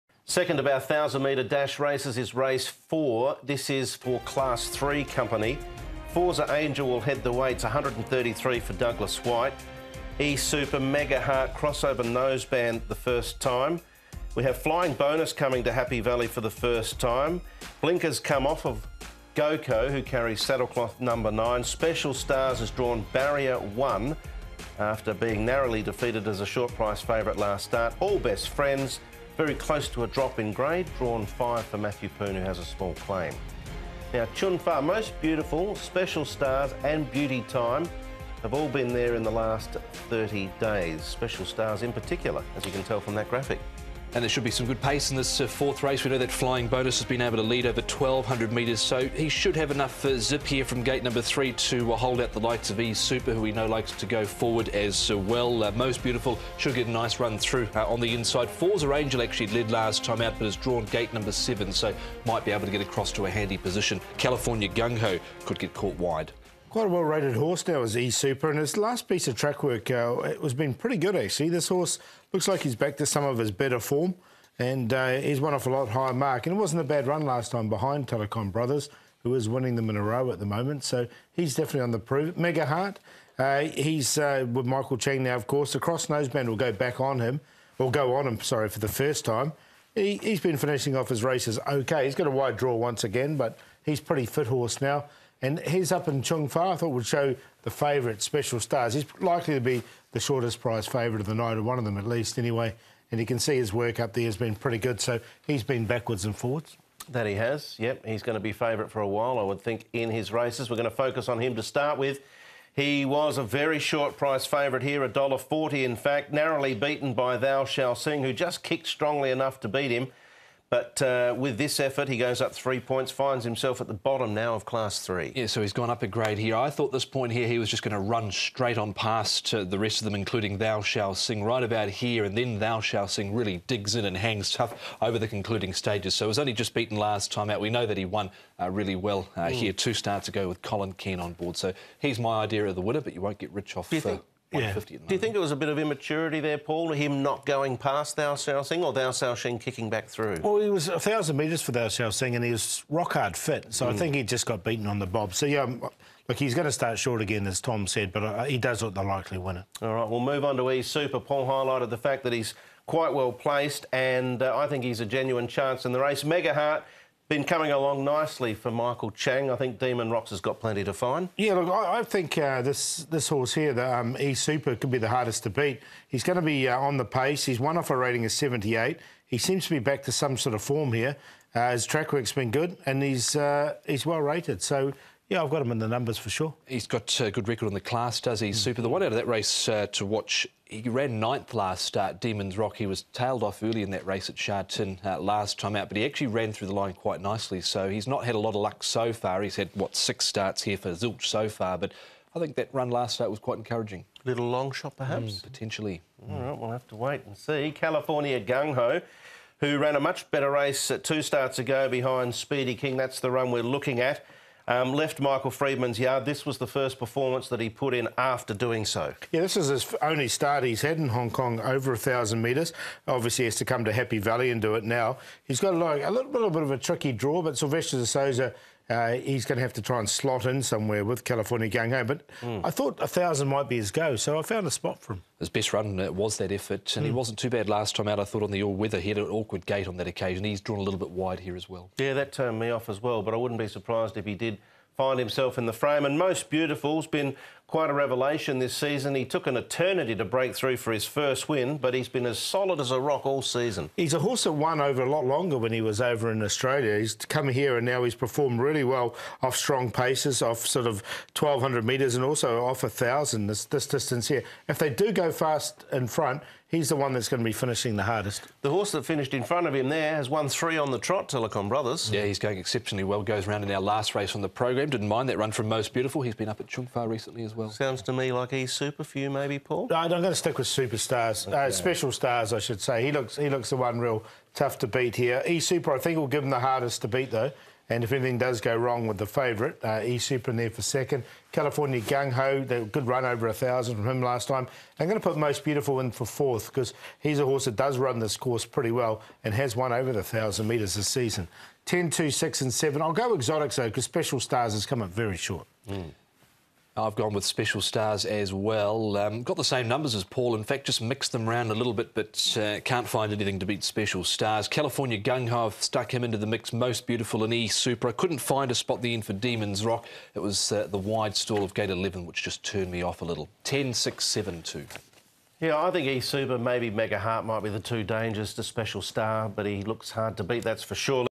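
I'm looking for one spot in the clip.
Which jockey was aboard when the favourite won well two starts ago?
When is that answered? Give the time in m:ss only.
2:20.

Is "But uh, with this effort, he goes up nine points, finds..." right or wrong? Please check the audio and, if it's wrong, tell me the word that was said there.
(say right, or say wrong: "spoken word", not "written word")
wrong: "three", not "nine".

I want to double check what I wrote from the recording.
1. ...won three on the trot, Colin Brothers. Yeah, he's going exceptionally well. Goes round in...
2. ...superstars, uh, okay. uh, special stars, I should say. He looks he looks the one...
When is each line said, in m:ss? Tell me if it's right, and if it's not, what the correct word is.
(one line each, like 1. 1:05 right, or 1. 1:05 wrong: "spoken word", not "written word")
1. 4:30 wrong: "Telecom", not "Colin"
2. 4:40 right.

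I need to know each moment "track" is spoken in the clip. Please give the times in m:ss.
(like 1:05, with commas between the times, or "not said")
1:09, 3:01.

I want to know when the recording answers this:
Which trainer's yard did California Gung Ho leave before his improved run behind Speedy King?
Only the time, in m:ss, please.
3:35.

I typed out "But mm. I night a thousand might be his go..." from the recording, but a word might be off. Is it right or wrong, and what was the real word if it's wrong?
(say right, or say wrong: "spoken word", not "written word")
wrong: "thought", not "night".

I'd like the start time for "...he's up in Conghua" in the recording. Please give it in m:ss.
1:35.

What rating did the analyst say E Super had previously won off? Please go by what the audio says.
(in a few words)
78.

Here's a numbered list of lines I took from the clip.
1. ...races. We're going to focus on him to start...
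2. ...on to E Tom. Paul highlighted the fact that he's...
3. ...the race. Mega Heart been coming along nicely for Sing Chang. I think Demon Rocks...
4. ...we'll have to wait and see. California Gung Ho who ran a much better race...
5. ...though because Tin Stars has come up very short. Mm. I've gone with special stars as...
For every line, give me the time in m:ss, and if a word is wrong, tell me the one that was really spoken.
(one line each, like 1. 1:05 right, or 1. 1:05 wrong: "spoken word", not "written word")
1. 1:50 right
2. 2:40 wrong: "Super", not "Tom"
3. 2:45 wrong: "Michael", not "Sing"
4. 3:26 right
5. 5:03 wrong: "Special", not "Tin".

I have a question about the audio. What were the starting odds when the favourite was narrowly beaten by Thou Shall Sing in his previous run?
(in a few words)
$1.40.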